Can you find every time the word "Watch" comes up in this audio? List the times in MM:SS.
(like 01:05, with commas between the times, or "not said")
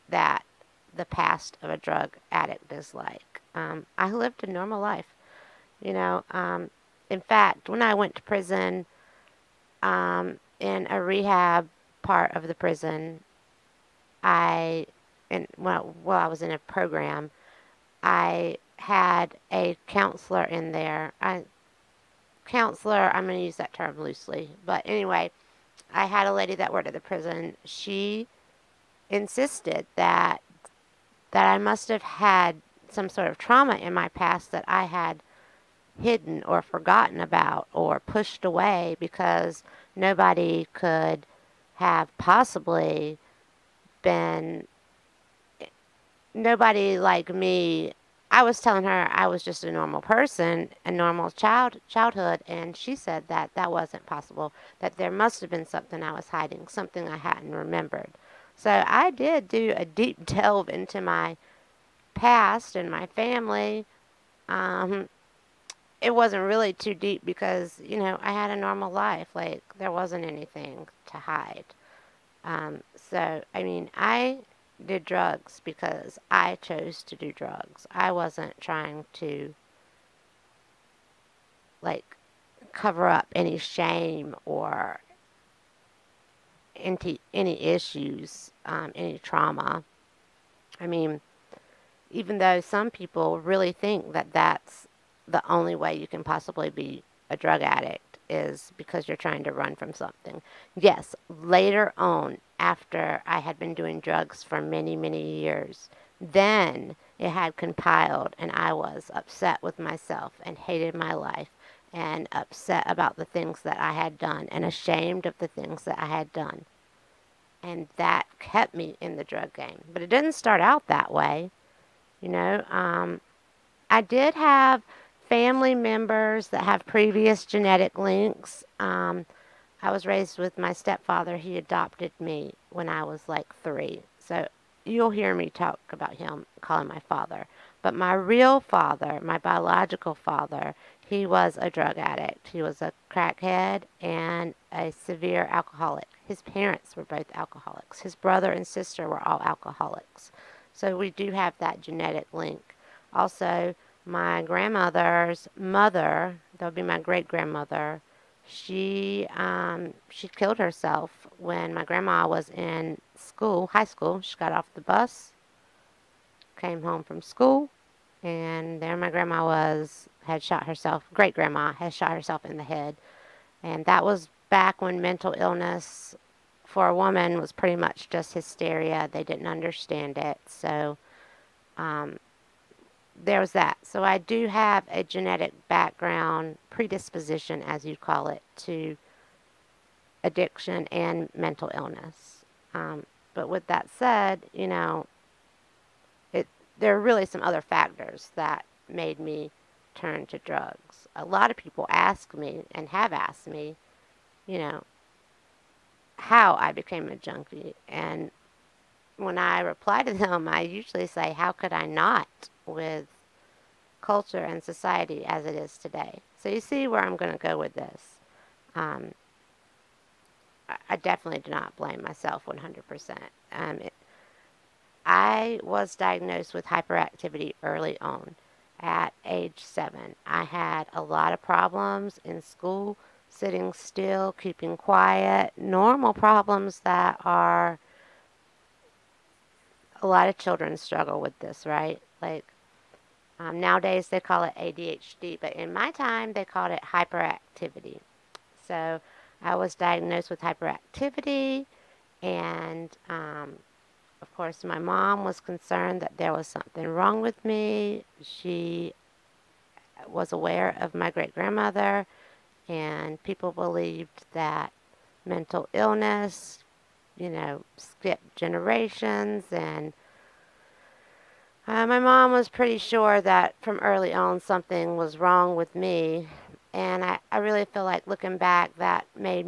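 not said.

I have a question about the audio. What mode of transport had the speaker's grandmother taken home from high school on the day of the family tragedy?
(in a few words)
the bus.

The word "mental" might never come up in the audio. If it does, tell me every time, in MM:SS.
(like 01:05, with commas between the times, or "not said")
02:55, 03:11, 04:25.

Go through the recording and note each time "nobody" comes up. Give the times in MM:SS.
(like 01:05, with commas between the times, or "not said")
00:39, 00:46.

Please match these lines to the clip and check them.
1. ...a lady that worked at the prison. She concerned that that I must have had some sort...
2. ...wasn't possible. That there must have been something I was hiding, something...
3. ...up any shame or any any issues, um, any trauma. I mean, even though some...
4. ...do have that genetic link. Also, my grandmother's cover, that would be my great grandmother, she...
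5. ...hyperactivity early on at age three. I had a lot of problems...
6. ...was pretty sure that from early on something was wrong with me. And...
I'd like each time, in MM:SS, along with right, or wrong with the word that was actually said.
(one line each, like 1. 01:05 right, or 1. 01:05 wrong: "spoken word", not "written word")
1. 00:26 wrong: "insisted", not "concerned"
2. 00:53 right
3. 01:23 right
4. 02:31 wrong: "mother", not "cover"
5. 03:46 wrong: "seven", not "three"
6. 04:32 right.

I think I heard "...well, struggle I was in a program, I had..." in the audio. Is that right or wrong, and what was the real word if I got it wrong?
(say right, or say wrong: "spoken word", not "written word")
wrong: "while", not "struggle".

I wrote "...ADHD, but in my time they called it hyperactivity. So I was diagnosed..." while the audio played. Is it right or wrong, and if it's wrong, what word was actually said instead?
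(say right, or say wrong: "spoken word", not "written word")
right.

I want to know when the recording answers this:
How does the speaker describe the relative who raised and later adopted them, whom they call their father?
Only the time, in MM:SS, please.
02:10.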